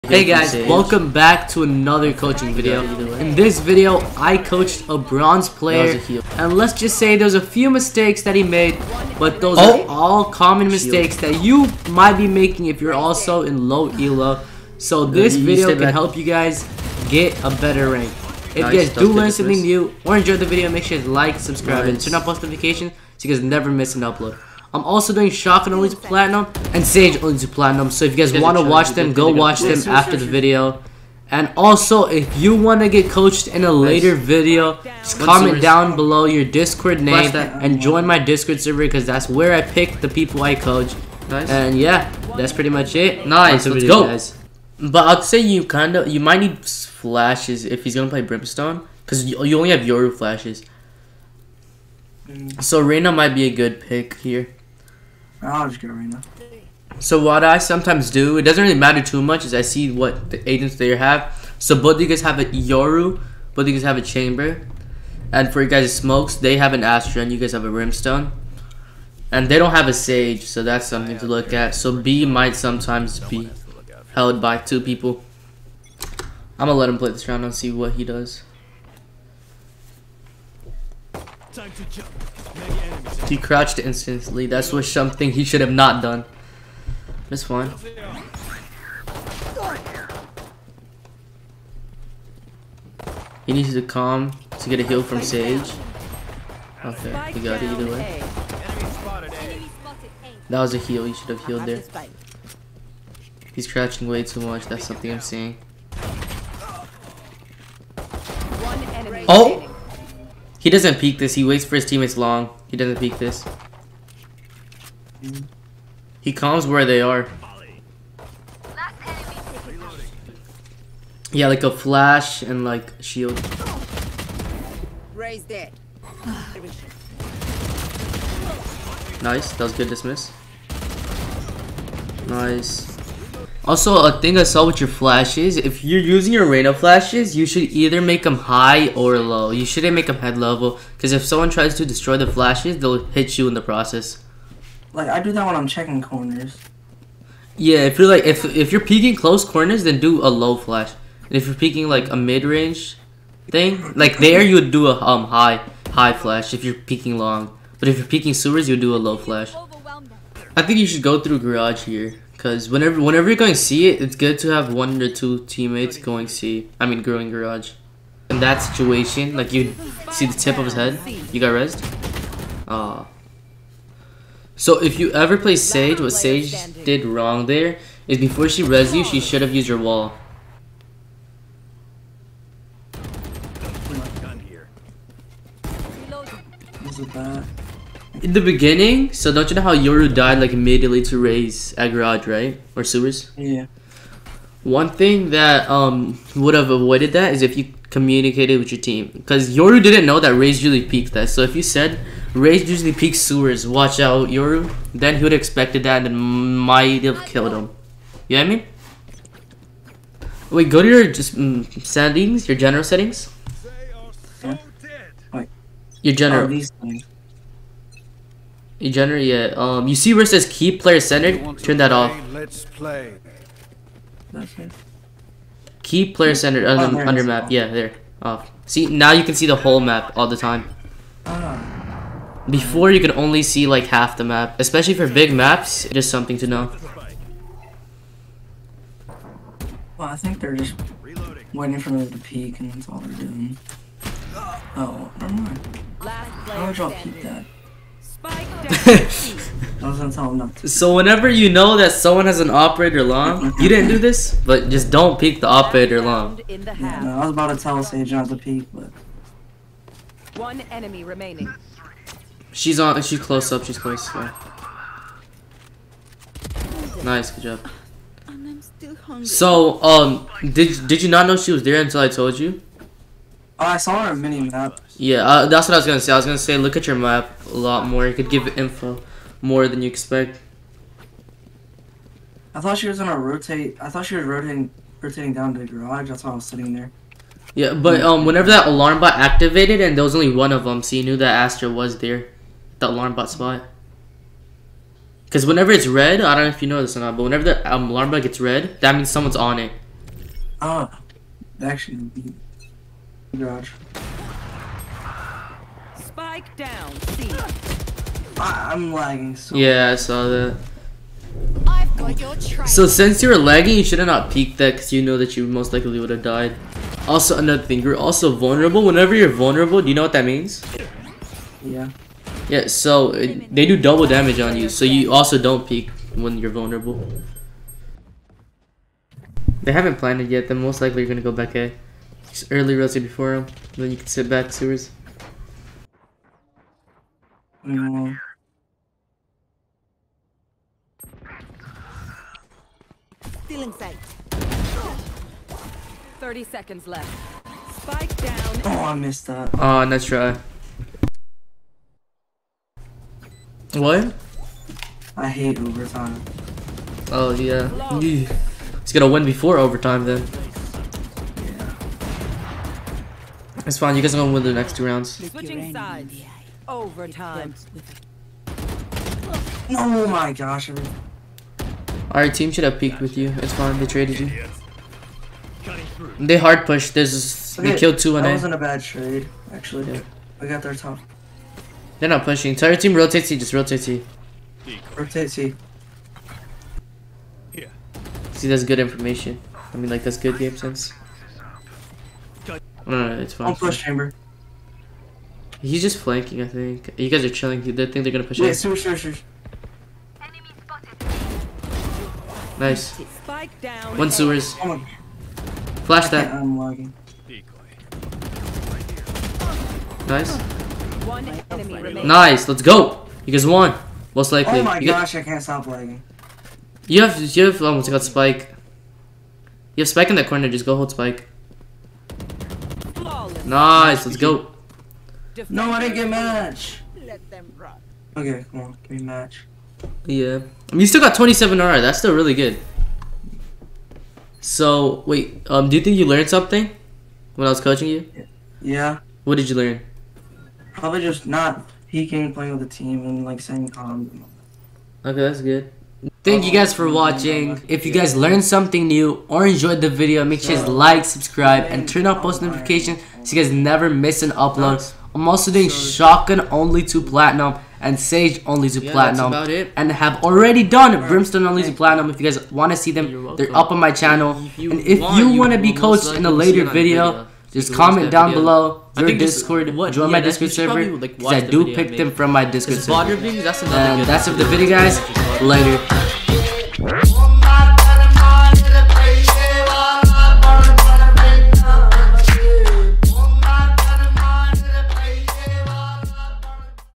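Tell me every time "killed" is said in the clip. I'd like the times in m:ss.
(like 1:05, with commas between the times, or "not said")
3:27, 6:17.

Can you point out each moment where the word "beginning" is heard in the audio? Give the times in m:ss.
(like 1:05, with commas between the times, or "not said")
3:08.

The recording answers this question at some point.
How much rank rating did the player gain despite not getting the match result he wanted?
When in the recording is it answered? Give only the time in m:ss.
7:11.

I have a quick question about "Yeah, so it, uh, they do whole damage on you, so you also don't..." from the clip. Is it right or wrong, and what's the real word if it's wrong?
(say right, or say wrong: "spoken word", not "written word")
wrong: "double", not "whole".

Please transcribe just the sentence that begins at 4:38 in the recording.
You could give info more than you expect.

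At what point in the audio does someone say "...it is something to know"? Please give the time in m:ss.
3:55.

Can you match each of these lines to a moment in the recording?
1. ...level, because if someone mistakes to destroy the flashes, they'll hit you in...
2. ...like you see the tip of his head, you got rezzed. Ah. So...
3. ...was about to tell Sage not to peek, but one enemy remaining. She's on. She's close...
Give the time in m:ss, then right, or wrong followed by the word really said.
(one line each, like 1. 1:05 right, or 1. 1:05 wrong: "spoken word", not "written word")
1. 2:20 wrong: "tries", not "mistakes"
2. 2:49 right
3. 4:17 right.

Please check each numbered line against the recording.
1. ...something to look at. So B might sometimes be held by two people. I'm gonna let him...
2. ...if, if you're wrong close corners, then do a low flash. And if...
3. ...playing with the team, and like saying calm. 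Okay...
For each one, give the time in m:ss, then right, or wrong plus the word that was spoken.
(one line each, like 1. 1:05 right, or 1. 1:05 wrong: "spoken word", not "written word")
1. 1:10 right
2. 2:28 wrong: "peeking", not "wrong"
3. 7:22 right.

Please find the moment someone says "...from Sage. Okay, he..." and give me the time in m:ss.
1:35.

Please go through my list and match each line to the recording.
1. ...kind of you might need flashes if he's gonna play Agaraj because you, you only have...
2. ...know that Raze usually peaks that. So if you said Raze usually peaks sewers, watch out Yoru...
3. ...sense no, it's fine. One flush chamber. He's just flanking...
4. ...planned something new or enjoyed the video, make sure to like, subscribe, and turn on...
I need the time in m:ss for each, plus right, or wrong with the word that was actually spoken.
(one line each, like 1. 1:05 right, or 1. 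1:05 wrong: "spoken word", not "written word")
1. 0:45 wrong: "Brimstone", not "Agaraj"
2. 3:20 right
3. 6:30 right
4. 7:28 wrong: "learned", not "planned".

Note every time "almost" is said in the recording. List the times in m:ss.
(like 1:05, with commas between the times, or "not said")
6:57.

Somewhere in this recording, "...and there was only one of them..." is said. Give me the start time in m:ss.
4:49.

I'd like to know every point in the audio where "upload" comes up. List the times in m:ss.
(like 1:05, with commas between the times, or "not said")
0:24, 7:34.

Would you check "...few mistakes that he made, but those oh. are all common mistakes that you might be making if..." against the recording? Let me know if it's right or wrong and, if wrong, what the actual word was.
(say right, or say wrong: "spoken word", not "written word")
right.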